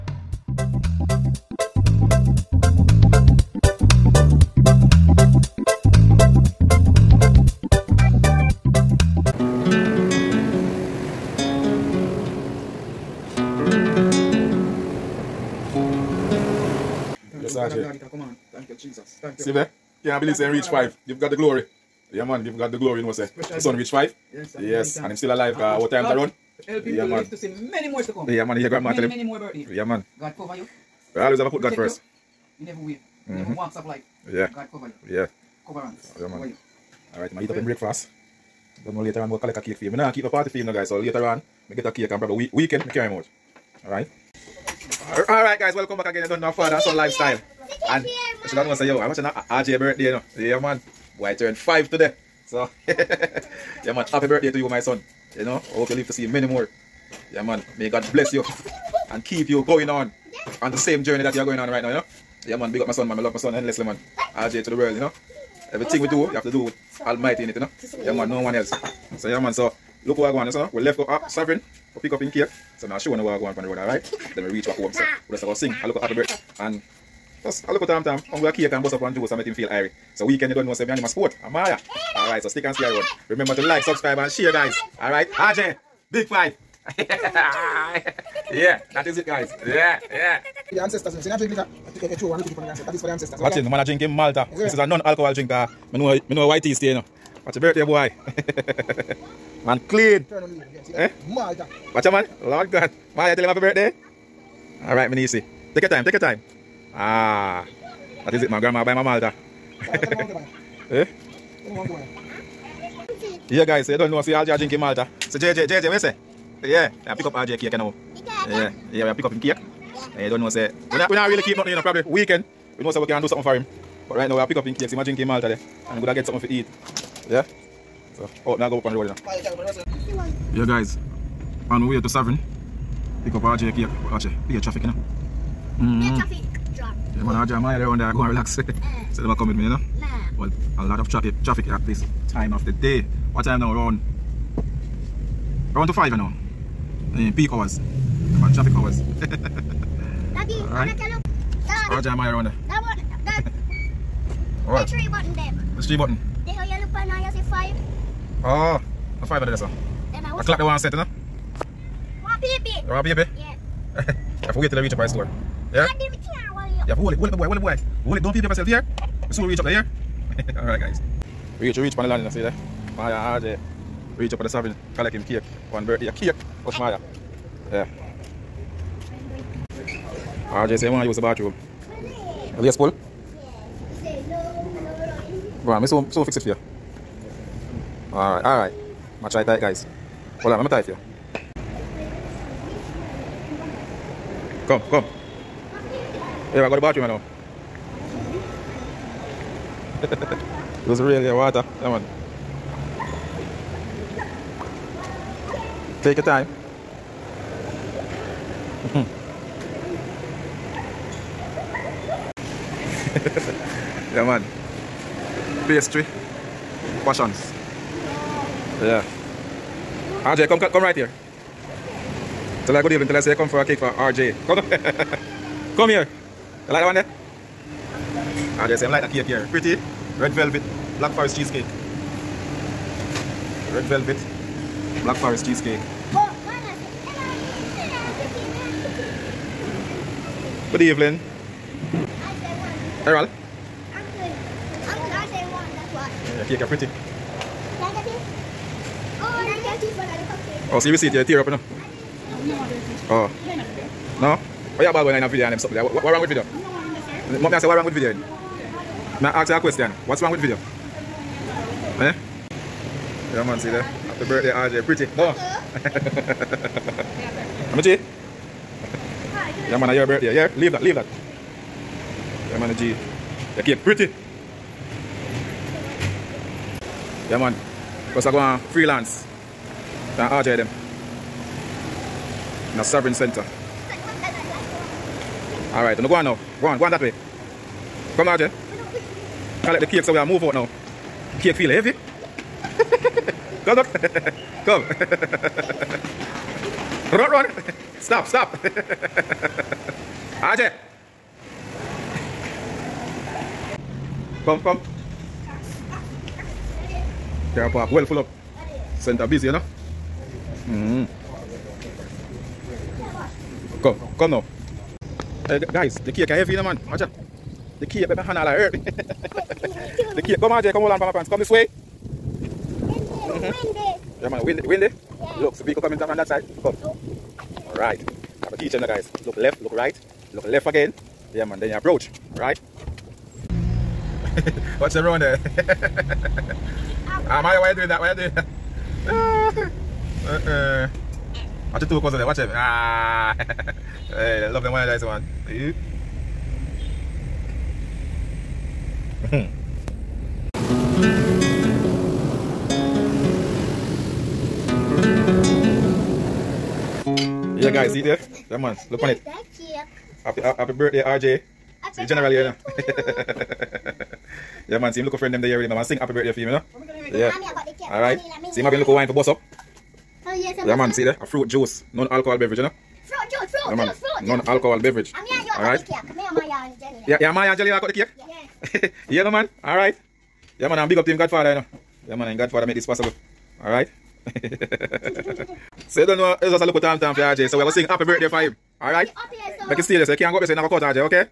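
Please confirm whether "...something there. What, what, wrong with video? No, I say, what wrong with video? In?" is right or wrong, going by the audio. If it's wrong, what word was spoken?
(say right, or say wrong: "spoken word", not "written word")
right.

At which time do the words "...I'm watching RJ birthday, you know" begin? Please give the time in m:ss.
0:49.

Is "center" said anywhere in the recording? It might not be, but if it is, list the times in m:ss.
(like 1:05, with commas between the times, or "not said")
4:43, 5:08.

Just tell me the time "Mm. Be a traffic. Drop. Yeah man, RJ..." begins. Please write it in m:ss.
2:15.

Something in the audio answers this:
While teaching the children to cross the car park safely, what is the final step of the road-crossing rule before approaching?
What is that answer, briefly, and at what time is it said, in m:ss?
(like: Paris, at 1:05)
Look left again, at 5:30.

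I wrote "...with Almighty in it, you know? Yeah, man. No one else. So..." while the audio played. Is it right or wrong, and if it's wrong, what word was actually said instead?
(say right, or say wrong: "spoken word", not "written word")
right.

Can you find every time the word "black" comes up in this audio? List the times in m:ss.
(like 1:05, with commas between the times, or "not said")
3:50, 3:55.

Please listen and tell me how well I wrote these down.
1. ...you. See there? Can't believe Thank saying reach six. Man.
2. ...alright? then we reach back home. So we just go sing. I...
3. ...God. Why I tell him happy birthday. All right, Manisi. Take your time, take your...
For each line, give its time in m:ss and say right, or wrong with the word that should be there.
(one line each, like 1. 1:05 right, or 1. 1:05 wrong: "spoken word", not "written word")
1. 0:19 wrong: "five", not "six"
2. 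1:13 right
3. 1:42 right.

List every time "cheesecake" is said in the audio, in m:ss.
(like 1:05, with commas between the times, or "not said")
3:51, 3:55.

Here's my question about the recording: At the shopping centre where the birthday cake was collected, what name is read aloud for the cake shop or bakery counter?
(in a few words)
Pastry Passions.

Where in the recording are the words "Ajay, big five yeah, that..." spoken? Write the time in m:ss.
1:25.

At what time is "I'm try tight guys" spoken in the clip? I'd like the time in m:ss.
3:09.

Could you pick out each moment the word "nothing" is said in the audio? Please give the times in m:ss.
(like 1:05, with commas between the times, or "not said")
2:01.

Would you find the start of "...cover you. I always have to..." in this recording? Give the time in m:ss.
0:30.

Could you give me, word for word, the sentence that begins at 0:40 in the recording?
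So later on, I get a cake and probably week weekend, I carry him out.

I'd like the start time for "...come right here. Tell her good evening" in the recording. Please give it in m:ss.
3:40.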